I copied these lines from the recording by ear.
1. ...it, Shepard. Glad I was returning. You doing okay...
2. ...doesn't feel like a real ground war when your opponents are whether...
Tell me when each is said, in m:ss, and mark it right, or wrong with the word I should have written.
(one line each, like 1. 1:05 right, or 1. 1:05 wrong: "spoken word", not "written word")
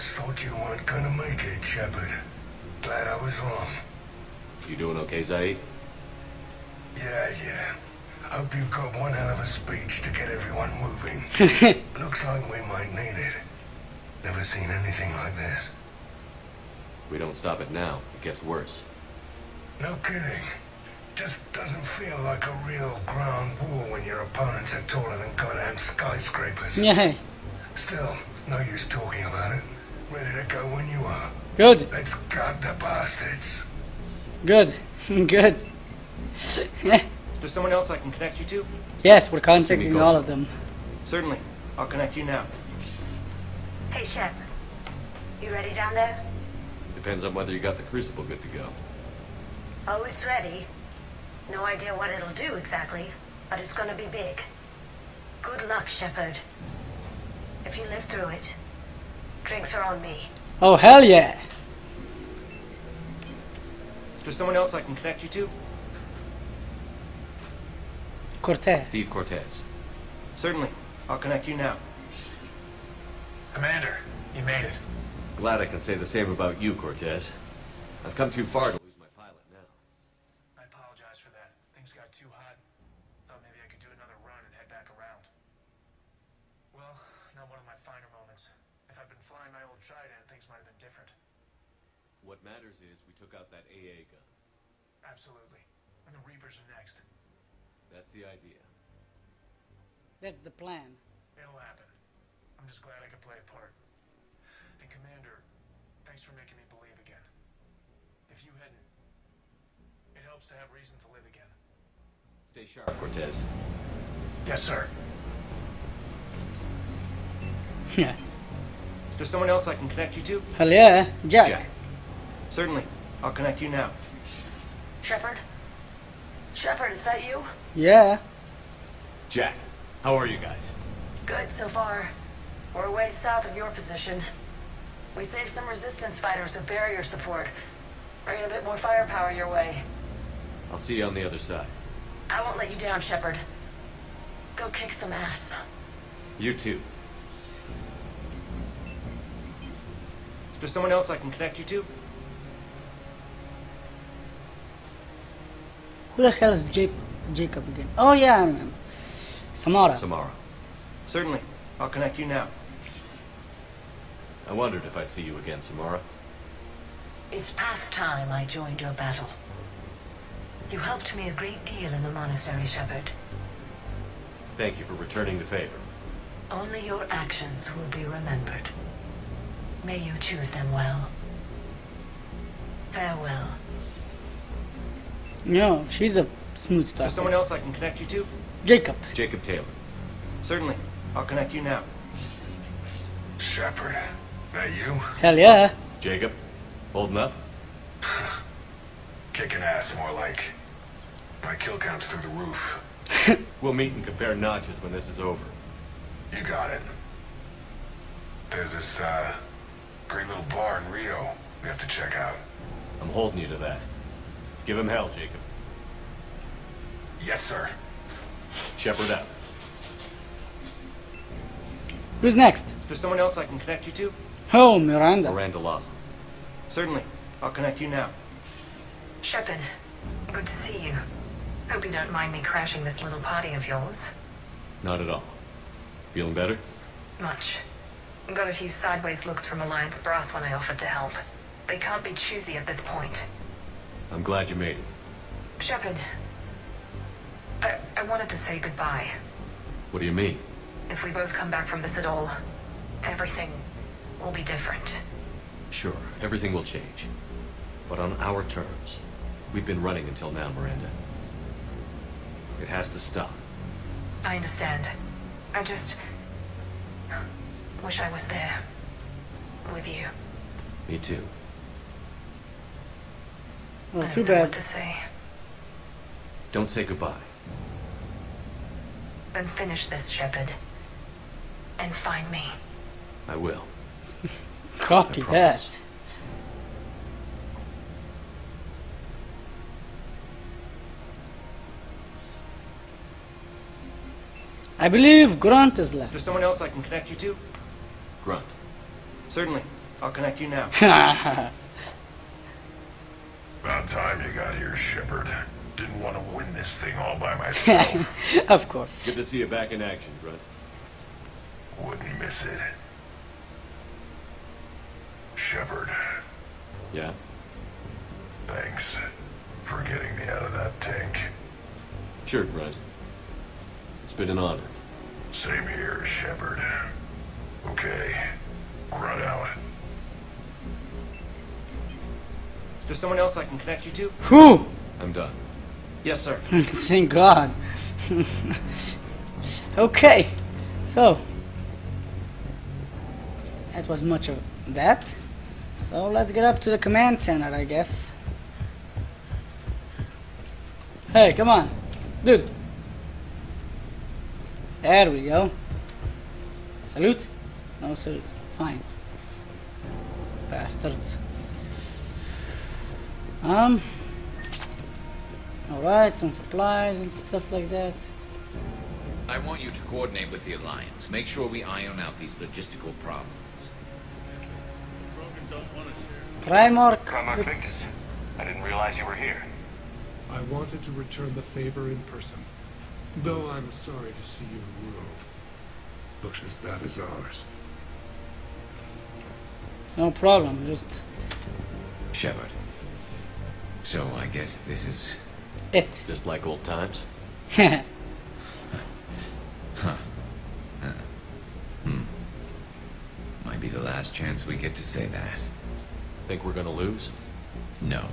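1. 0:01 wrong: "wrong", not "returning"
2. 0:21 wrong: "taller", not "whether".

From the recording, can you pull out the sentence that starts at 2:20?
I'll see you on the other side.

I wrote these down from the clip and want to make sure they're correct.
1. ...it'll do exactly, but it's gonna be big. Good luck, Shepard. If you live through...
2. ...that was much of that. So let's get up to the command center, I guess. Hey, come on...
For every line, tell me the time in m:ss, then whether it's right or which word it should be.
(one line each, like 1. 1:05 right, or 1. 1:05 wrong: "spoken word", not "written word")
1. 0:52 right
2. 5:43 right.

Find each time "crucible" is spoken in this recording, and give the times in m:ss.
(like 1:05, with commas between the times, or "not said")
0:47.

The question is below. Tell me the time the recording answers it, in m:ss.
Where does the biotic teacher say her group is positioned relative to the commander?
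2:12.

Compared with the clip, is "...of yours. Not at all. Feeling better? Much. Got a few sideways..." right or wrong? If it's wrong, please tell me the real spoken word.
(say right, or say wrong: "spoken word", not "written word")
right.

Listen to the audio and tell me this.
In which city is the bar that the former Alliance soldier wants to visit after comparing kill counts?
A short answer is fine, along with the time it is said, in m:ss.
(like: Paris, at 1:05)
Rio, at 3:30.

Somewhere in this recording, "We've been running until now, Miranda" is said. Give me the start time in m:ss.
4:19.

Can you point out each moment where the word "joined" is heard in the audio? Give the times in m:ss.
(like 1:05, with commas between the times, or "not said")
2:48.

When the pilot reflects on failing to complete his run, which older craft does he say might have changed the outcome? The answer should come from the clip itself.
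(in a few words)
Trident.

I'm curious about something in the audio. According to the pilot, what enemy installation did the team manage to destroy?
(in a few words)
AA gun.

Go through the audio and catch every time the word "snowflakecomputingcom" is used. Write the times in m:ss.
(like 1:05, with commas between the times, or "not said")
not said.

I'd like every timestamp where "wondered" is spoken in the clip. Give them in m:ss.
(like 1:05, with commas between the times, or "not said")
2:44.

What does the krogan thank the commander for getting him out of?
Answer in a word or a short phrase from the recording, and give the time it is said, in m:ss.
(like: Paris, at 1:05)
That tank, at 5:20.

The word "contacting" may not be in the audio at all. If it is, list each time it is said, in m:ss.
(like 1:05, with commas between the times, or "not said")
0:39.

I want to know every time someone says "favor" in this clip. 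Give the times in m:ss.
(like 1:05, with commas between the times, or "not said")
2:55, 6:21.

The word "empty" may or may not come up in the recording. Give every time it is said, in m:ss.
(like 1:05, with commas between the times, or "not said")
not said.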